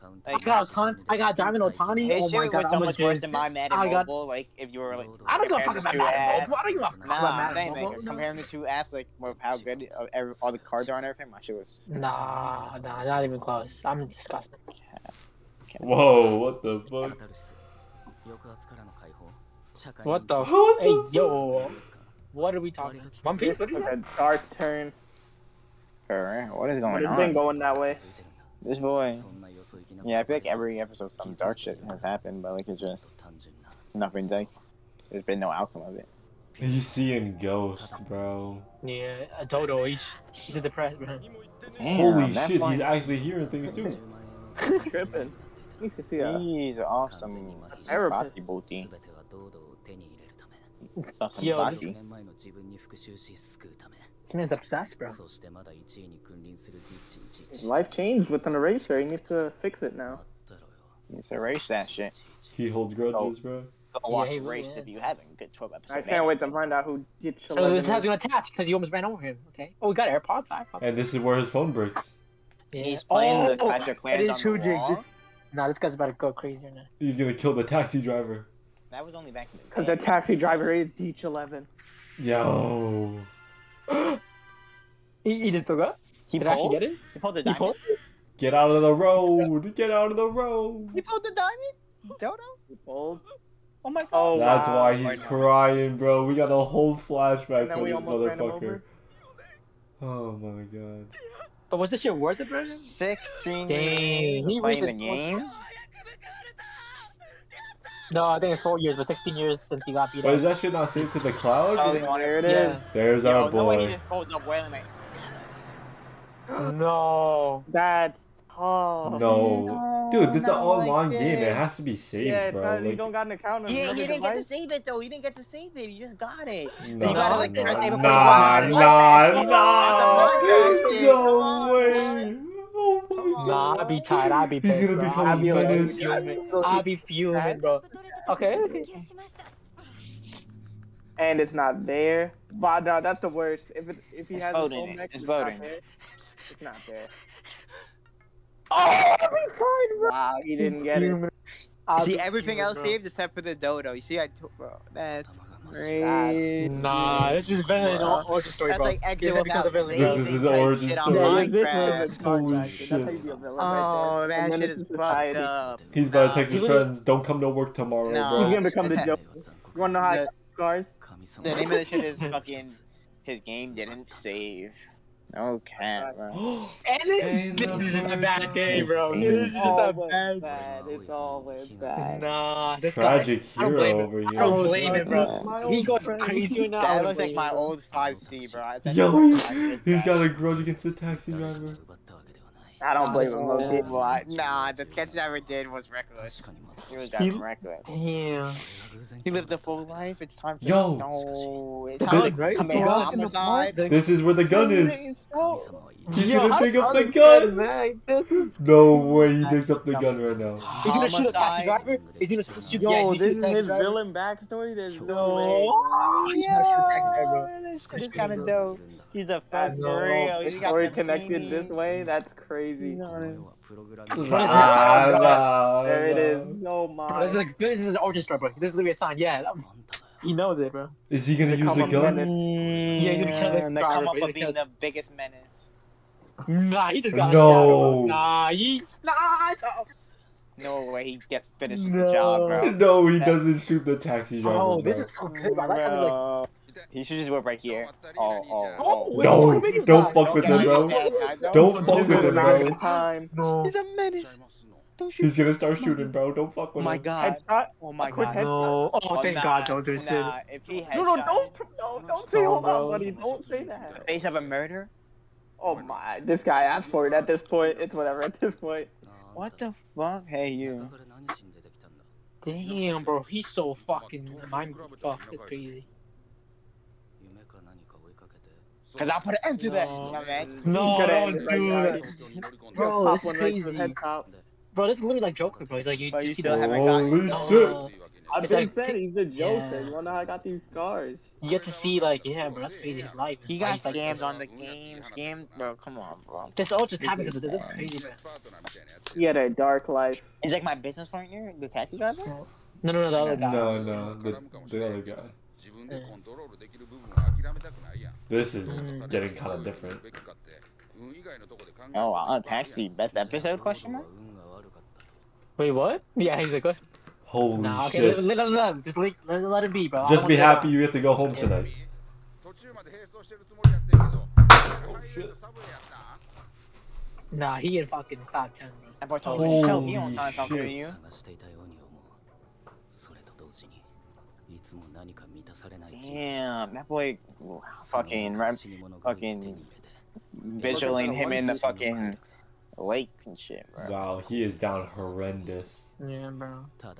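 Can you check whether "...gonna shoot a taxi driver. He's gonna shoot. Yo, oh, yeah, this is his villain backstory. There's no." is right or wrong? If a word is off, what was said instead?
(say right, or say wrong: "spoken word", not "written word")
right.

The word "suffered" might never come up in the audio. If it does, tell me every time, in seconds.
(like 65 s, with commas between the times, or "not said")
not said.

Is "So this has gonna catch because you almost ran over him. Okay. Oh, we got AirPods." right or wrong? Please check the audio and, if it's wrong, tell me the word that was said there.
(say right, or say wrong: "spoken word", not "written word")
wrong: "attach", not "catch".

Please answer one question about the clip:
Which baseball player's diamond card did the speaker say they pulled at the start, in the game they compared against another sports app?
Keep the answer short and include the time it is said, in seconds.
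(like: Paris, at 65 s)
Ohtani, at 1 s.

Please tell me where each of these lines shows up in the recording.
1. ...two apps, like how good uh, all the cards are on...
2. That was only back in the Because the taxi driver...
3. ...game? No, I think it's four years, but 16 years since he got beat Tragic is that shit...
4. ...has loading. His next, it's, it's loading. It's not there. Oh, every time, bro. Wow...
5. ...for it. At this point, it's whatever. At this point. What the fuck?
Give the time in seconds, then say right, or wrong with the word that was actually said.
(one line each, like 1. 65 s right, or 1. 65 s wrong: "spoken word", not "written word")
1. 8 s right
2. 78 s right
3. 104 s wrong: "But", not "Tragic"
4. 144 s right
5. 266 s right.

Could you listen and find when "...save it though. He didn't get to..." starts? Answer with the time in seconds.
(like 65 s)
124 s.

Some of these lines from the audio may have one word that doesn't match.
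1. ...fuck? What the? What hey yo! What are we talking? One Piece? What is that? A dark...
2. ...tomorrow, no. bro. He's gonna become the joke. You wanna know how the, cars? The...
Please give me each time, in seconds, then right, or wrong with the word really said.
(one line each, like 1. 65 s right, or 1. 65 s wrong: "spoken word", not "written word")
1. 16 s right
2. 167 s right.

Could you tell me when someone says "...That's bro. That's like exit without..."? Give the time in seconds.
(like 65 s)
158 s.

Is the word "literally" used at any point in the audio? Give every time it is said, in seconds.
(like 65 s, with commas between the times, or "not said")
228 s, 285 s.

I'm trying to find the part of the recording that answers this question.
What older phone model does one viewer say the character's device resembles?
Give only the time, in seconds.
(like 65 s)
187 s.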